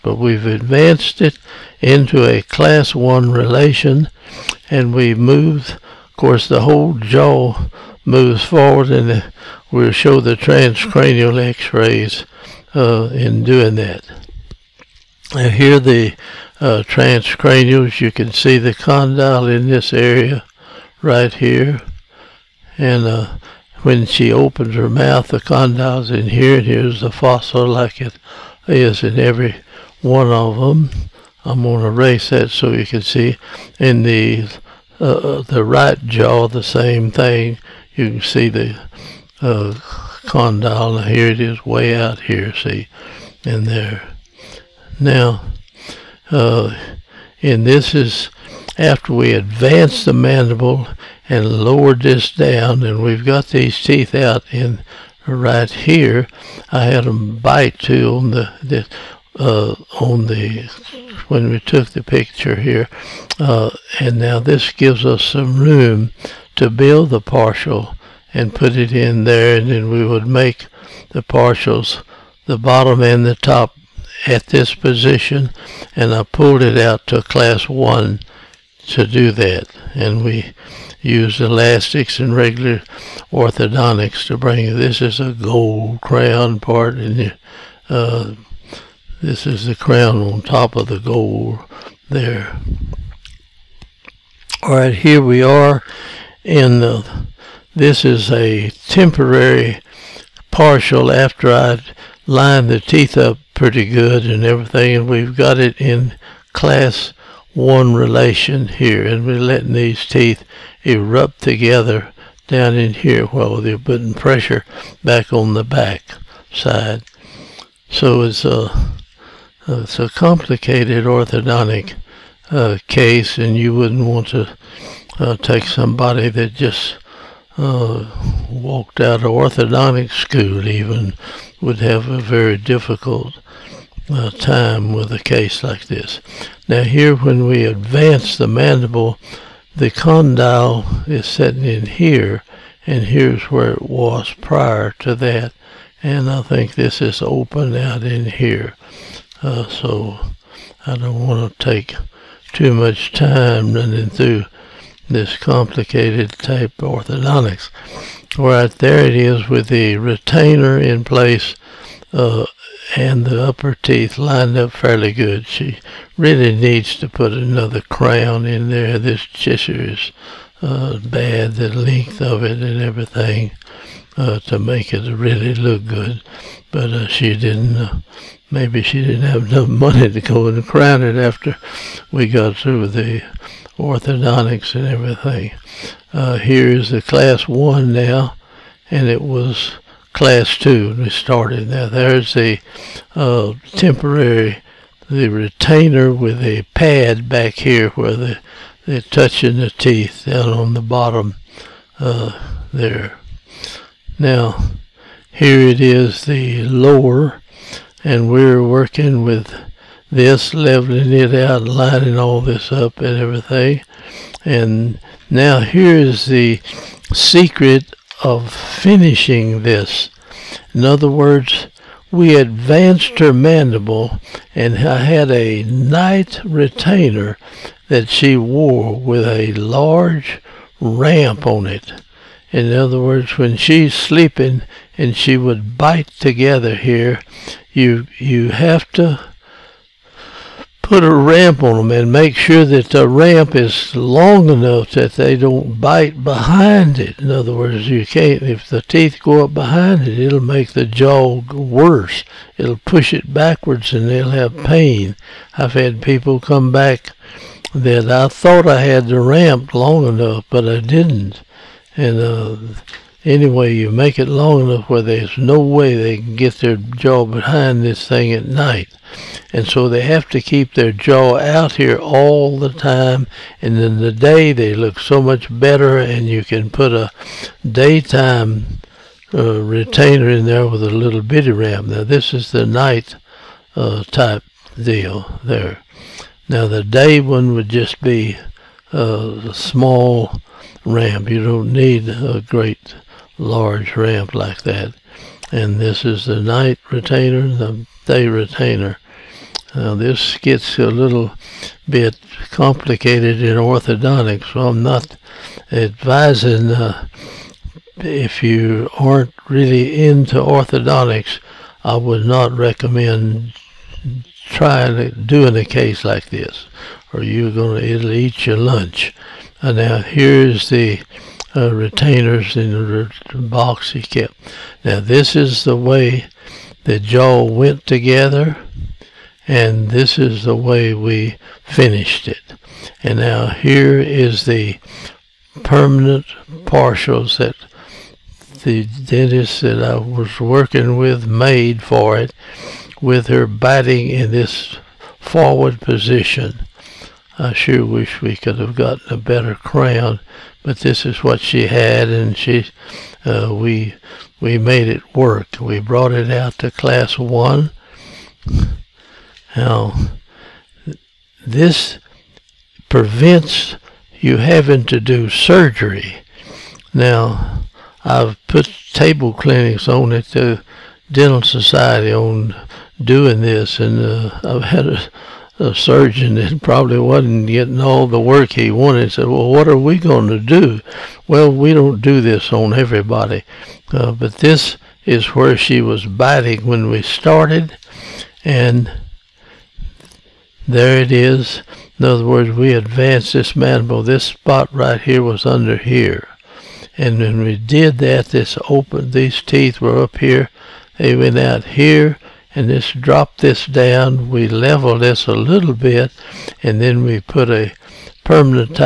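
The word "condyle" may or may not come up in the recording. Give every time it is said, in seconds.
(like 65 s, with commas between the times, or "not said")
18 s, 25 s, 40 s, 139 s.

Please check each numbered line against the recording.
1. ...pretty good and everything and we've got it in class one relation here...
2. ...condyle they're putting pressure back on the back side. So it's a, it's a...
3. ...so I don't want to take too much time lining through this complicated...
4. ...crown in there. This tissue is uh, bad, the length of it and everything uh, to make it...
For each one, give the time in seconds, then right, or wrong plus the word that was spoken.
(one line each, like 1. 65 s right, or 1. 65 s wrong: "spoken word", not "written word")
1. 103 s right
2. 113 s wrong: "while", not "condyle"
3. 149 s wrong: "running", not "lining"
4. 167 s right.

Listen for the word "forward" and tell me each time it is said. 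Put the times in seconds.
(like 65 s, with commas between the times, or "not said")
8 s, 345 s.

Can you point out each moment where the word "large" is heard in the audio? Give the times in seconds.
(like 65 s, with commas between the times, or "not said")
229 s, 293 s.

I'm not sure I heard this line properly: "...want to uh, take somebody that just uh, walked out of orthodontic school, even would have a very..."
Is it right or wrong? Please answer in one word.
right.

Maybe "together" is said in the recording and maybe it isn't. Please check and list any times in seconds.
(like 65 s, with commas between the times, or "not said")
111 s, 236 s, 327 s.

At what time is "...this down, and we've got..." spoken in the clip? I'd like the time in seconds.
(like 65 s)
52 s.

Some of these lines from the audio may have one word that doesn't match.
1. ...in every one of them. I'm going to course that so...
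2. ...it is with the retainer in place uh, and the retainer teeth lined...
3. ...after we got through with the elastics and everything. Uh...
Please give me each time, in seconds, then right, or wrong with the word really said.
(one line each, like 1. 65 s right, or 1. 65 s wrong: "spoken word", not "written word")
1. 29 s wrong: "erase", not "course"
2. 159 s wrong: "upper", not "retainer"
3. 181 s wrong: "orthodontics", not "elastics".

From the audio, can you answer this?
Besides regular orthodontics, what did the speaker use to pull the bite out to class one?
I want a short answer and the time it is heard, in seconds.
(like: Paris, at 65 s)
elastics, at 81 s.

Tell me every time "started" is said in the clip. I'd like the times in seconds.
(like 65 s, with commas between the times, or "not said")
191 s, 387 s.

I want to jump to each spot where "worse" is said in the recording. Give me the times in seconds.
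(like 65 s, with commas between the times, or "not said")
251 s.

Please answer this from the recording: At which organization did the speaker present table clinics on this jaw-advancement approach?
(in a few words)
Dental Society.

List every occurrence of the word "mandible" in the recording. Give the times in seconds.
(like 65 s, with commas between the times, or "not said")
50 s, 138 s, 223 s, 393 s.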